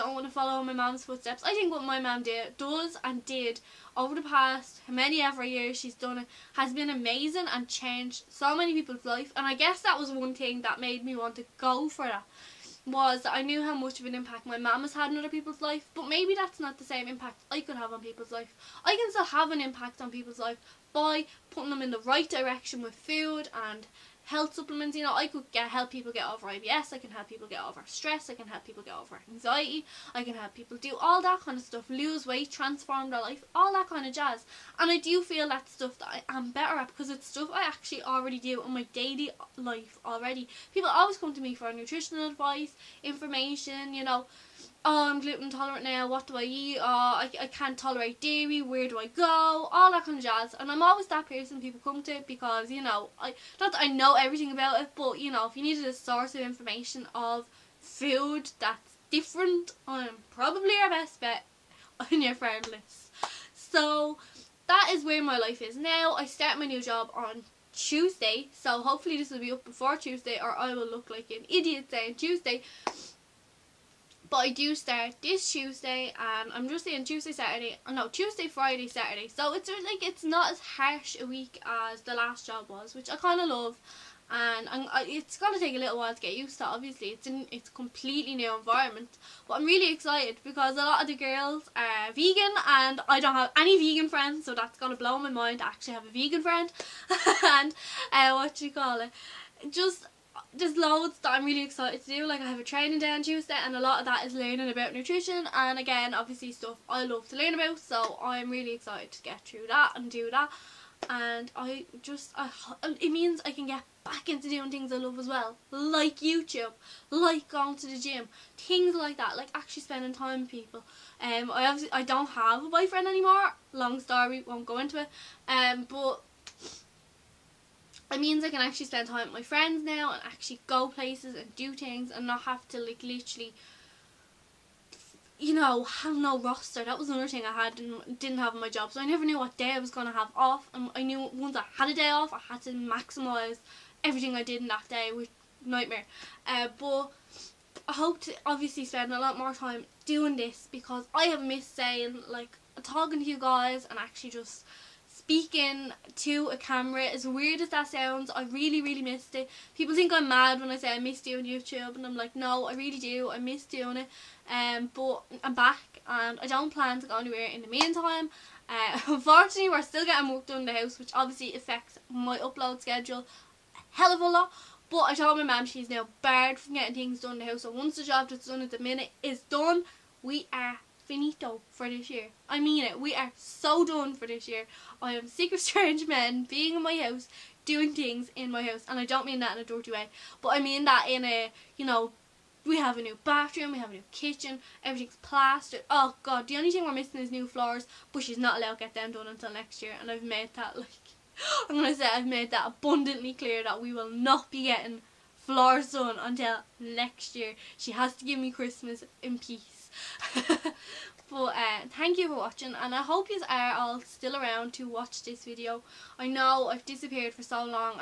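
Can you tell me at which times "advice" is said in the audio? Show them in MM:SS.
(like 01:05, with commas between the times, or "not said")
00:42.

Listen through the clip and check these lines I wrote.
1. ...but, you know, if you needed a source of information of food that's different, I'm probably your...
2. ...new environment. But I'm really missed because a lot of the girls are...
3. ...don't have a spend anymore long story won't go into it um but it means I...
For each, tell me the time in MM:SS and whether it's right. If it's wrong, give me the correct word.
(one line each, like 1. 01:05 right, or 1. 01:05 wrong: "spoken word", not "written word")
1. 00:54 right
2. 01:28 wrong: "excited", not "missed"
3. 02:02 wrong: "boyfriend", not "spend".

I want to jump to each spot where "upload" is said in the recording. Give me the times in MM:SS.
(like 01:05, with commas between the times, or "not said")
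02:52.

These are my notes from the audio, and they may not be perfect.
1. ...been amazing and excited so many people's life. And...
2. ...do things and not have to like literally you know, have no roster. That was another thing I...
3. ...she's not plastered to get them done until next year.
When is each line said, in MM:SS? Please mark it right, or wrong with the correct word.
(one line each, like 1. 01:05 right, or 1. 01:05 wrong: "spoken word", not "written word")
1. 00:06 wrong: "changed", not "excited"
2. 02:11 right
3. 03:18 wrong: "allowed", not "plastered".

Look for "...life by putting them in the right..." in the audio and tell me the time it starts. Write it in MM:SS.
00:20.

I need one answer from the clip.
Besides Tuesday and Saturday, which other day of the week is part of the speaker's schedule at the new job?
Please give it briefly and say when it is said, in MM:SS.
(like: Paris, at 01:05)
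Friday, at 01:18.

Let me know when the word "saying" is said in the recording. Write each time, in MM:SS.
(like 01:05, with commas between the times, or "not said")
01:11, 01:16, 02:31.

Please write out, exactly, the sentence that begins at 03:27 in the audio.
She has to give me Christmas in peace.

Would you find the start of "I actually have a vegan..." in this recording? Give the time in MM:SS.
01:35.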